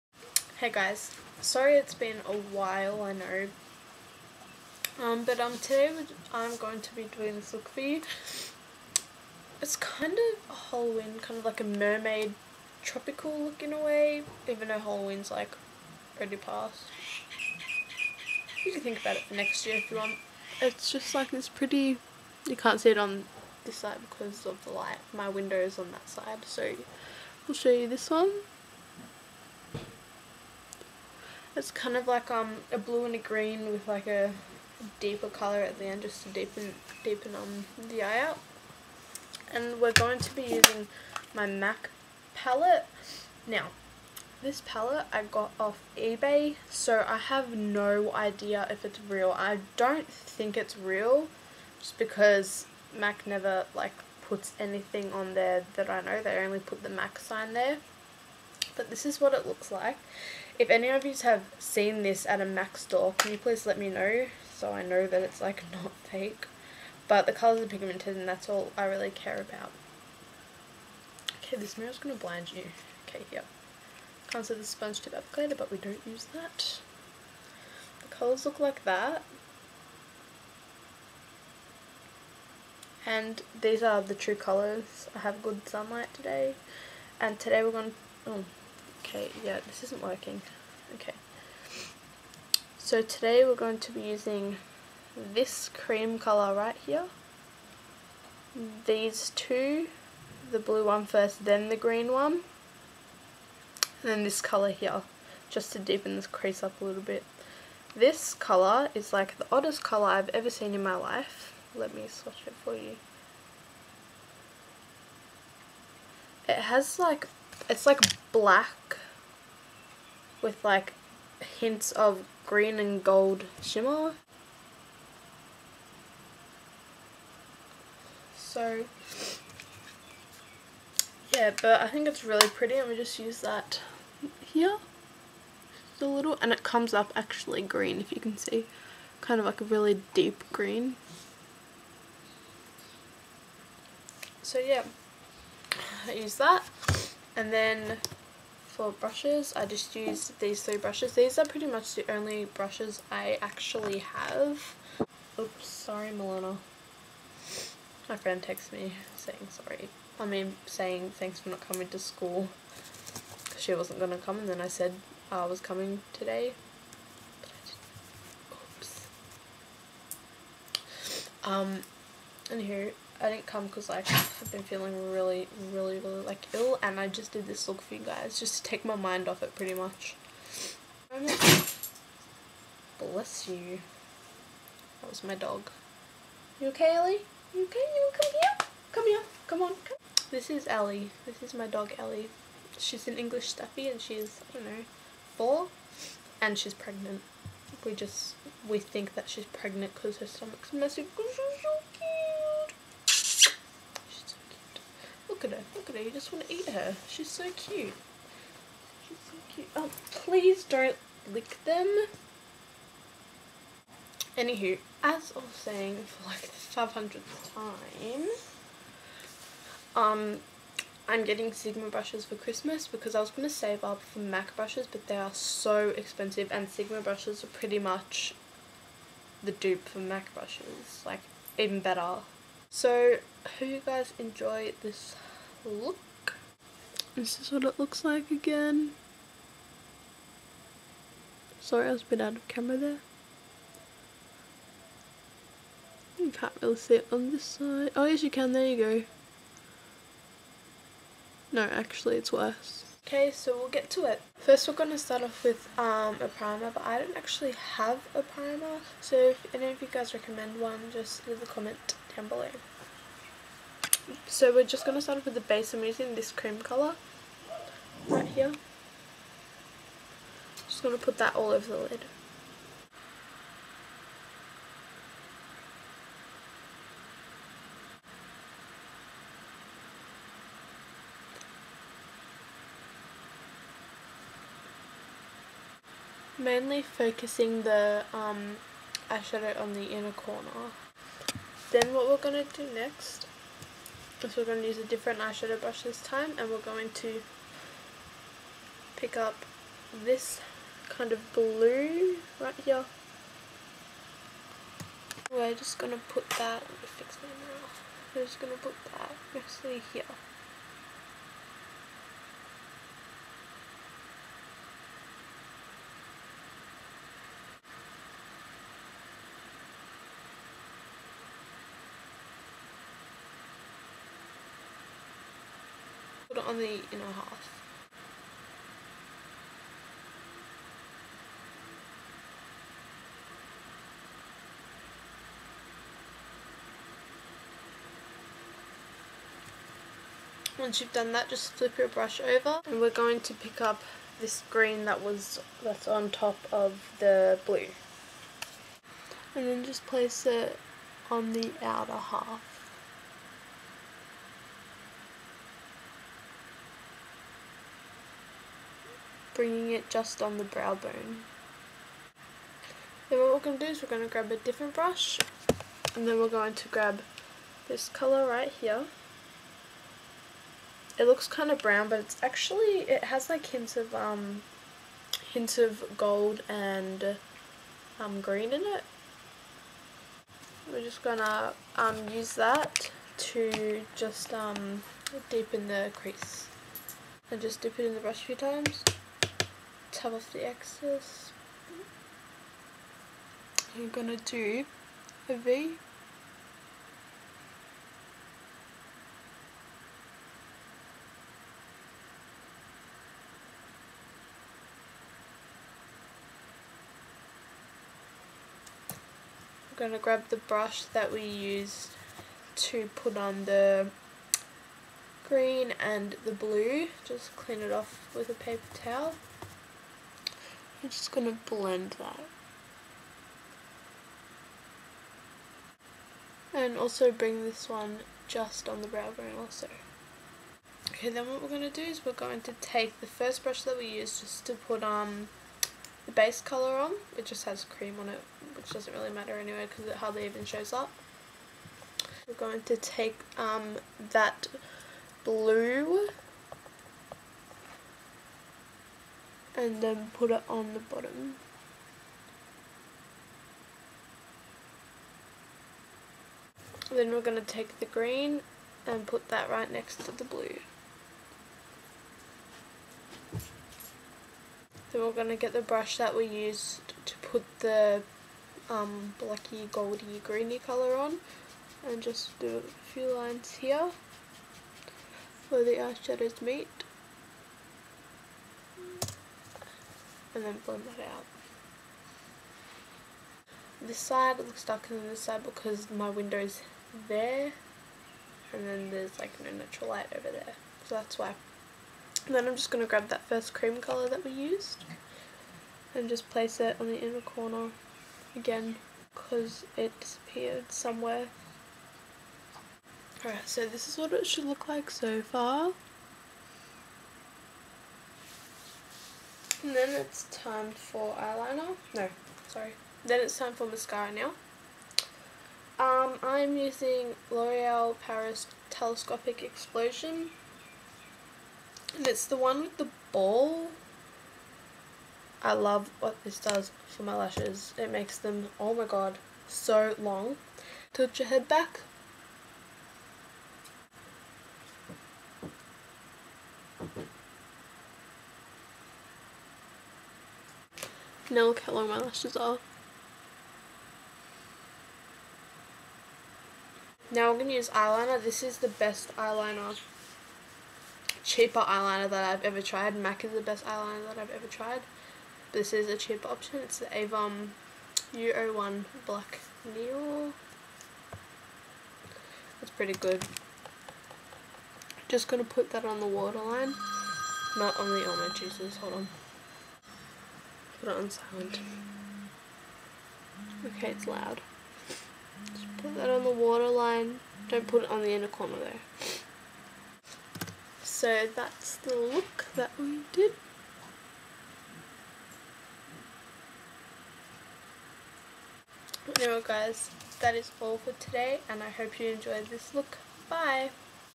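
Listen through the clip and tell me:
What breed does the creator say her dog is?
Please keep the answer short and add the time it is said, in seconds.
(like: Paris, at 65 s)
English Staffy, at 193 s.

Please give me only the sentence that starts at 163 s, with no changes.
She wasn't going to come and then I said I was coming today.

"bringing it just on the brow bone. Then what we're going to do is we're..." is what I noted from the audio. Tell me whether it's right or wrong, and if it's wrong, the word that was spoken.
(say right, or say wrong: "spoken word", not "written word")
right.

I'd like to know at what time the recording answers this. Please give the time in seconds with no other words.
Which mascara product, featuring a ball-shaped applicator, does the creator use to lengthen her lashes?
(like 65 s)
517 s.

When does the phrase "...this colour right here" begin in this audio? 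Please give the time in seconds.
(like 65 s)
367 s.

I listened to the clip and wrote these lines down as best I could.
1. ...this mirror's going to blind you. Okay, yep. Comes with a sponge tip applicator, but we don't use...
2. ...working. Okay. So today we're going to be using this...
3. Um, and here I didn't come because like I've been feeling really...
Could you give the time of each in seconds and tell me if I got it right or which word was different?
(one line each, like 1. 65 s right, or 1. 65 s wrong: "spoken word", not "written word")
1. 71 s right
2. 90 s right
3. 171 s right.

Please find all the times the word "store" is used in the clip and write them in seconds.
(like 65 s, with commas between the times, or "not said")
62 s.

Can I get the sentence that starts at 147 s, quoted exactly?
And then for brushes, I just used these three brushes.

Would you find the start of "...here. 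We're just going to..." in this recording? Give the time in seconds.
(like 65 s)
302 s.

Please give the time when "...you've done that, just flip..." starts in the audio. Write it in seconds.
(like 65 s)
340 s.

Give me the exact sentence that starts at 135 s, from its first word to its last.
Just a little and it comes up actually green if you can see.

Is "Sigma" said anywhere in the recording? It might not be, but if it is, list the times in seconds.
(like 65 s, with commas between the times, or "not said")
221 s, 226 s.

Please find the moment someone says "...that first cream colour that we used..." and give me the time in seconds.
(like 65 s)
493 s.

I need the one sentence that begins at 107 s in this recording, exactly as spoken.
This colour is like the oddest colour I've ever seen in my life.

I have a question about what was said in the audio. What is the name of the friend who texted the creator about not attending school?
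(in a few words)
Milena.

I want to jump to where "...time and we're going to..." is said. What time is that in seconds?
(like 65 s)
296 s.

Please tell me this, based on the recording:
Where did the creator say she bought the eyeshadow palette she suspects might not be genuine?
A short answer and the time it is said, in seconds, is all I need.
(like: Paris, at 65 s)
eBay, at 45 s.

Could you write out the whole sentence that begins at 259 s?
So if any of you guys recommend one, just leave a comment down below.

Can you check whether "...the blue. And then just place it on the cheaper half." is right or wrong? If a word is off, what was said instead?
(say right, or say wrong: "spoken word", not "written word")
wrong: "outer", not "cheaper".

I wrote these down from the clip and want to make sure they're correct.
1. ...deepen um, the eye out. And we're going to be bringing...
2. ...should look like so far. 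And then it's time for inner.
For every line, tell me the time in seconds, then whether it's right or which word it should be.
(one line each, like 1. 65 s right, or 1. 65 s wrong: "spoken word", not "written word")
1. 37 s wrong: "using", not "bringing"
2. 504 s wrong: "eyeliner", not "inner".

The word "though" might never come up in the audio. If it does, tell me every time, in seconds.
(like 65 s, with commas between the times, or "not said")
14 s, 578 s.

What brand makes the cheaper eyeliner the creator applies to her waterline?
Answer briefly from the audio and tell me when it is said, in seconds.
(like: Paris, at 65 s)
Avon, at 556 s.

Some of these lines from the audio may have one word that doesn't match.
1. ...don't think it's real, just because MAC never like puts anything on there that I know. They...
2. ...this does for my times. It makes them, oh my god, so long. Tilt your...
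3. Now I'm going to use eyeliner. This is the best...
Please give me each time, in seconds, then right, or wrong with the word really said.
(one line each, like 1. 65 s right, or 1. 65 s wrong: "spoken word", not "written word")
1. 49 s right
2. 526 s wrong: "lashes", not "times"
3. 547 s right.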